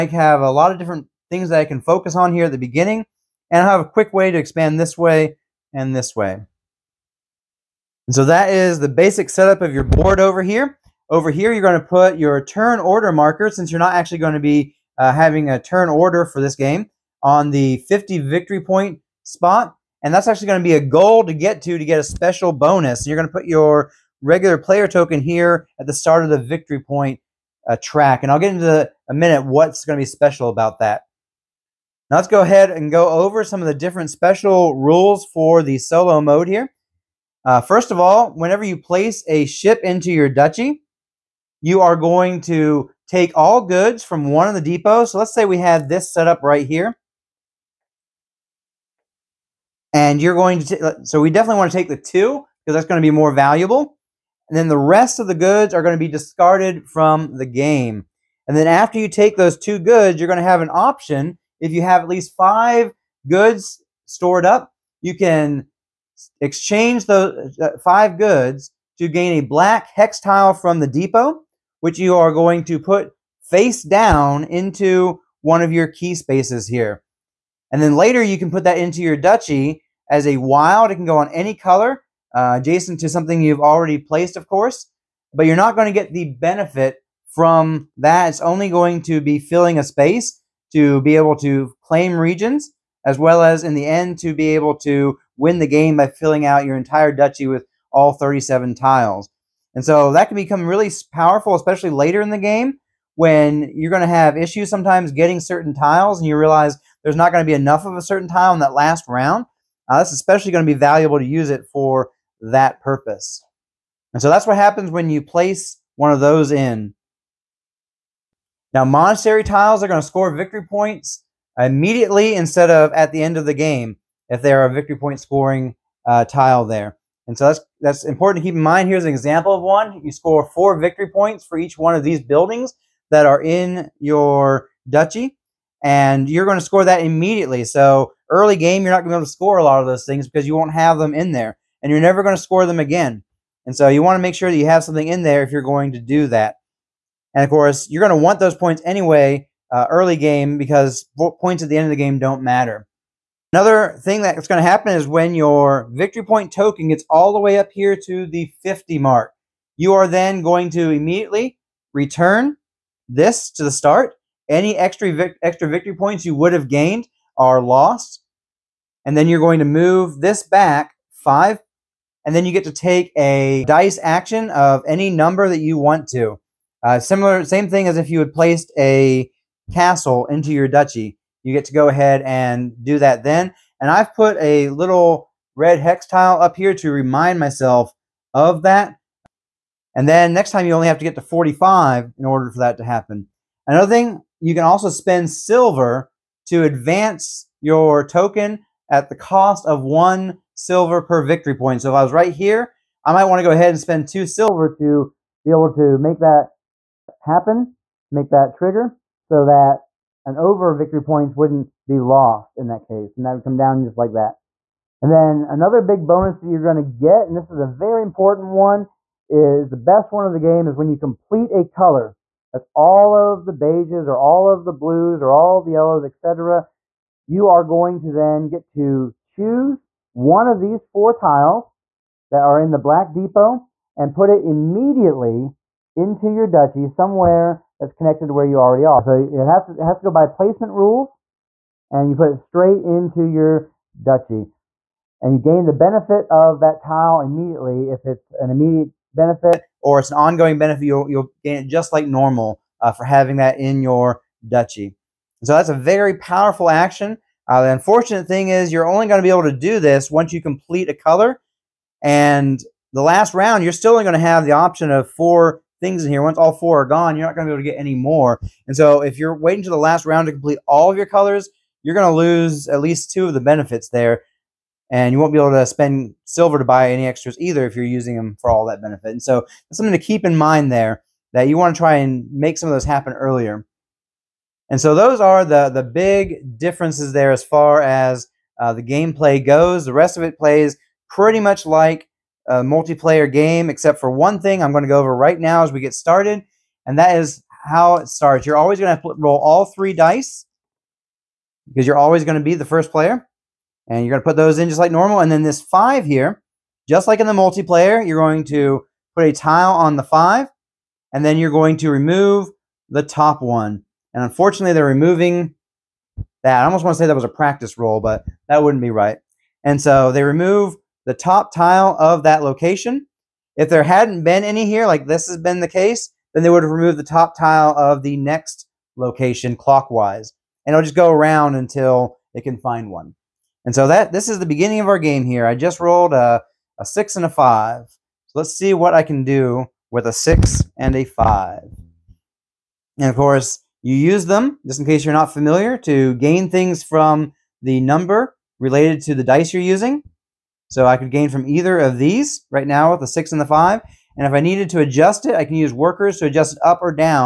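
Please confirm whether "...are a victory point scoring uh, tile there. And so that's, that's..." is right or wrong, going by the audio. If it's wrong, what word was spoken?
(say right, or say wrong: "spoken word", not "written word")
right.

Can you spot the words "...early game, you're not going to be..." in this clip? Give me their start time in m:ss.
2:18.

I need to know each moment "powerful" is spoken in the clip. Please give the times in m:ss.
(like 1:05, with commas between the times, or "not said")
1:41, 4:16.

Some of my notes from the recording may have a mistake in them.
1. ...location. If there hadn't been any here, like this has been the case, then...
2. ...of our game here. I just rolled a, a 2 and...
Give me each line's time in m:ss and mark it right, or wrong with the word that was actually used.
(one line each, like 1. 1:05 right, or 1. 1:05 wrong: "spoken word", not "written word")
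1. 5:22 right
2. 5:34 wrong: "6", not "2".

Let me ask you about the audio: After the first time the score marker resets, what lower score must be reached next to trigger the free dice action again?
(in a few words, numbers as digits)
45.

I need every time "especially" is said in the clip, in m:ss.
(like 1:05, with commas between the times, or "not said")
1:41, 1:50.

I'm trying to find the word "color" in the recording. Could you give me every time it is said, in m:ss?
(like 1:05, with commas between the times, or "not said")
1:21, 3:41, 4:20, 4:31.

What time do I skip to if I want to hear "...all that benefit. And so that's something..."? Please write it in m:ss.
4:38.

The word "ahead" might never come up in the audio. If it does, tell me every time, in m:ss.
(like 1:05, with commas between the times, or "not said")
0:32, 3:01, 3:23.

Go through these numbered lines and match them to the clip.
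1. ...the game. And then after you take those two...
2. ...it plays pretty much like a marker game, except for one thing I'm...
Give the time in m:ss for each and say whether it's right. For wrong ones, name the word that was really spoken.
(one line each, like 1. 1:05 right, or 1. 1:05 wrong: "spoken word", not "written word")
1. 0:57 right
2. 4:50 wrong: "multiplayer", not "marker".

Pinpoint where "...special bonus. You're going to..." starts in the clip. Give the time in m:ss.
0:22.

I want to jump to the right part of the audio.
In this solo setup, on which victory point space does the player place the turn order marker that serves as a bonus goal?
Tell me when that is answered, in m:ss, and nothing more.
0:17.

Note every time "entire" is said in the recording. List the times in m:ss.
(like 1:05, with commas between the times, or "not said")
1:36.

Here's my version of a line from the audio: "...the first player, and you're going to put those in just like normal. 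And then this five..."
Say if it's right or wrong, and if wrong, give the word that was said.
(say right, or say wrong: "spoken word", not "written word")
right.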